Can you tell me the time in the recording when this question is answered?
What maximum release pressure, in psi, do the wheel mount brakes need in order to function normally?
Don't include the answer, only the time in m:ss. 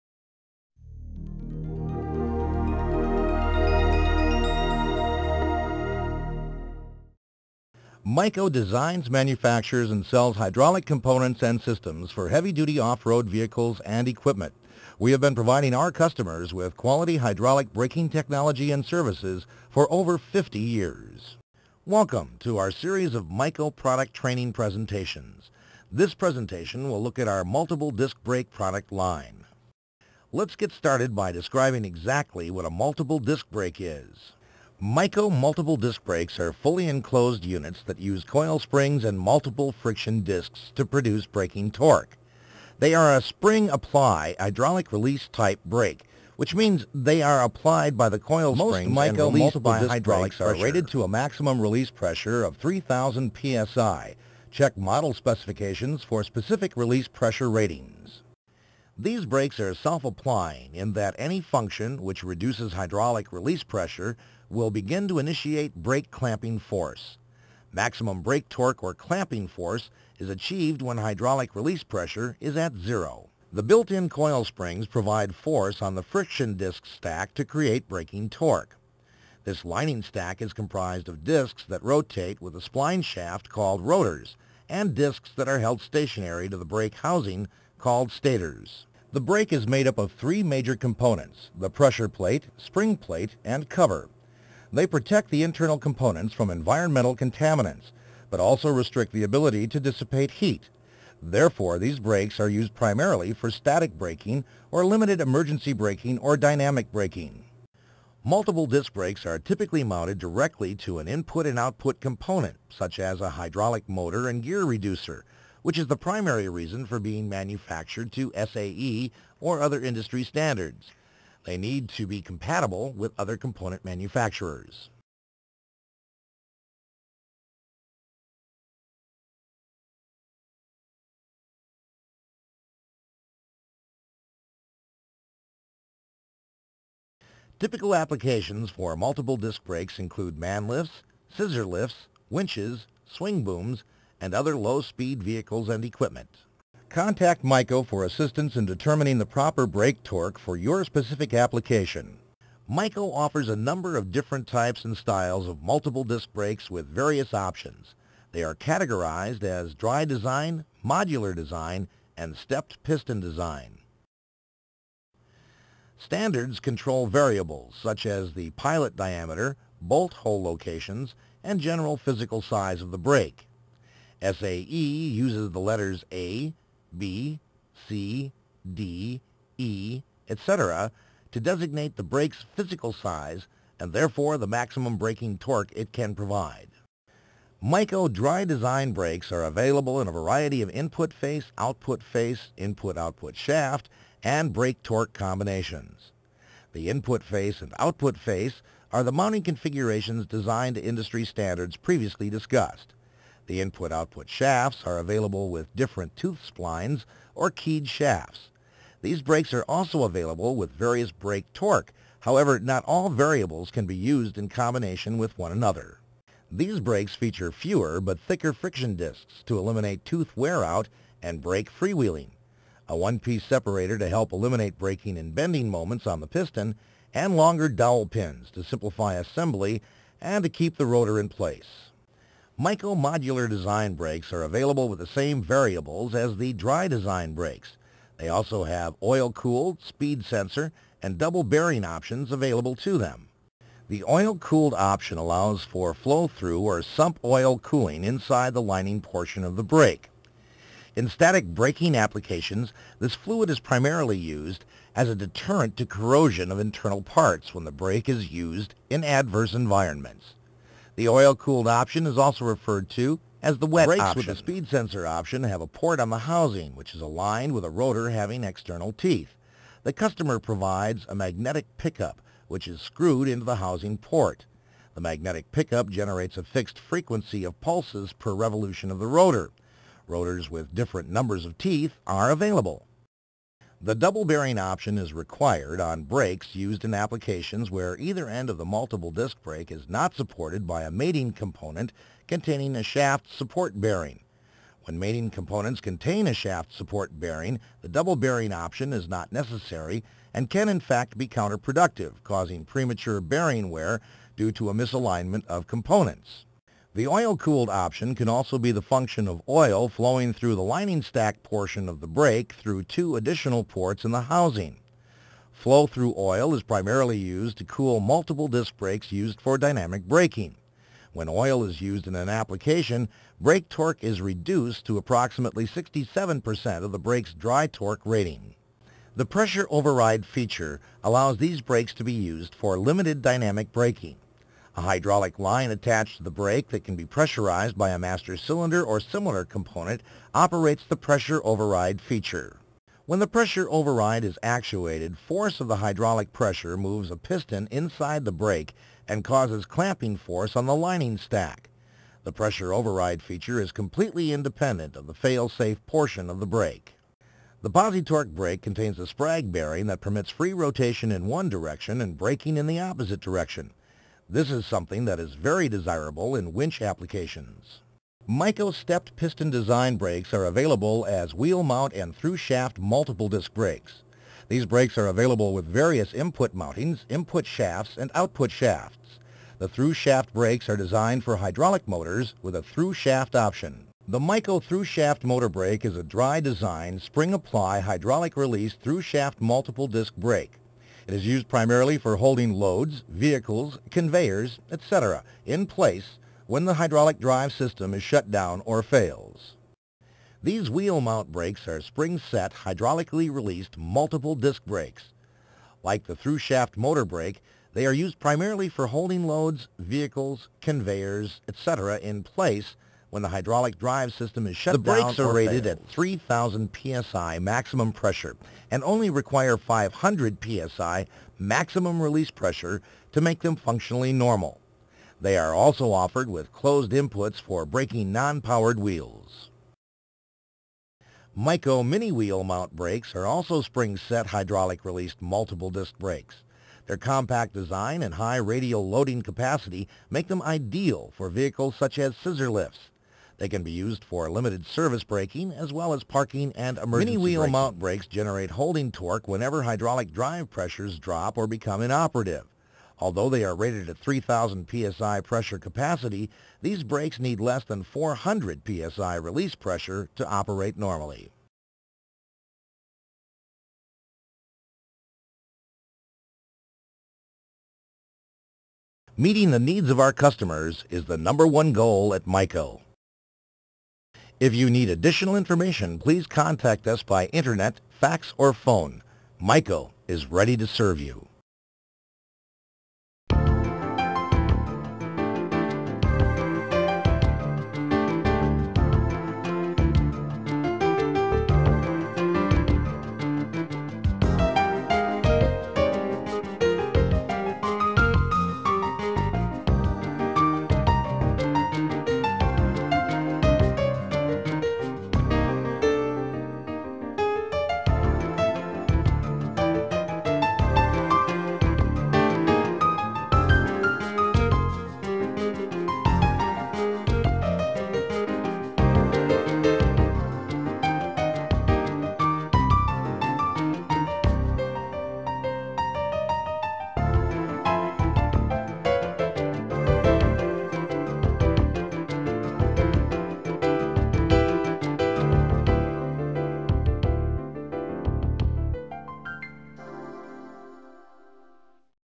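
6:59.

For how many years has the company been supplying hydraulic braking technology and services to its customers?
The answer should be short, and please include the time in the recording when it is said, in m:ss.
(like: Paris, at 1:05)
over 50 years, at 0:19.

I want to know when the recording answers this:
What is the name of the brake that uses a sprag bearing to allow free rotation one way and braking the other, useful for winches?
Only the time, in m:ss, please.
5:57.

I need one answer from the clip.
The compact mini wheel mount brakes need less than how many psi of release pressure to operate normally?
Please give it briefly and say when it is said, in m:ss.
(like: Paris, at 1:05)
400 psi, at 7:37.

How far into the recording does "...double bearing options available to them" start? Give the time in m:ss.
4:01.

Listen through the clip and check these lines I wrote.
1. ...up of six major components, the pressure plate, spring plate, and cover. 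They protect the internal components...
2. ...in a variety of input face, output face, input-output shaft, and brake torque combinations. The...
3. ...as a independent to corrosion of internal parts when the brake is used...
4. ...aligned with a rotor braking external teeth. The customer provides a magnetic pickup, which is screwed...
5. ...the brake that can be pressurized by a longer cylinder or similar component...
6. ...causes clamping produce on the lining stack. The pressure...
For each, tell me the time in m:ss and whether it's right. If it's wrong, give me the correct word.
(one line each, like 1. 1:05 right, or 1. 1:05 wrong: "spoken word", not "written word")
1. 1:29 wrong: "three", not "six"
2. 3:10 right
3. 4:14 wrong: "deterrent", not "independent"
4. 4:27 wrong: "having", not "braking"
5. 5:36 wrong: "master", not "longer"
6. 5:49 wrong: "force", not "produce".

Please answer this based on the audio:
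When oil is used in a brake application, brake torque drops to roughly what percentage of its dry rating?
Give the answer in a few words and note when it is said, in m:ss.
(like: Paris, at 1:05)
67%, at 5:25.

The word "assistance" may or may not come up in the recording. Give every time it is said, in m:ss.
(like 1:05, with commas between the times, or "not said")
2:28.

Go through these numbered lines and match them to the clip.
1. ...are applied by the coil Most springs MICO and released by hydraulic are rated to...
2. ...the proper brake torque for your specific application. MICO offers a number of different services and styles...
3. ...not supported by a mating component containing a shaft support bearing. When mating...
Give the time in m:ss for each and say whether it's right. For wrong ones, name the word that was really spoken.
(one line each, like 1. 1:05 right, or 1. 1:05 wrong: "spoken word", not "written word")
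1. 0:47 right
2. 2:29 wrong: "types", not "services"
3. 4:49 right.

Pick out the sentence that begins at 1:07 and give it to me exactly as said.
Maximum brake torque or clamping force is achieved when hydraulic release pressure is at zero.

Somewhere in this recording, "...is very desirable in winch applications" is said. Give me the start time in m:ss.
6:05.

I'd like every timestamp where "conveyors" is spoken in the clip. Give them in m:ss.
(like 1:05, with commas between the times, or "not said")
6:33, 6:50.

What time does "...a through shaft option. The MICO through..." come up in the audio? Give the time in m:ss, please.
6:22.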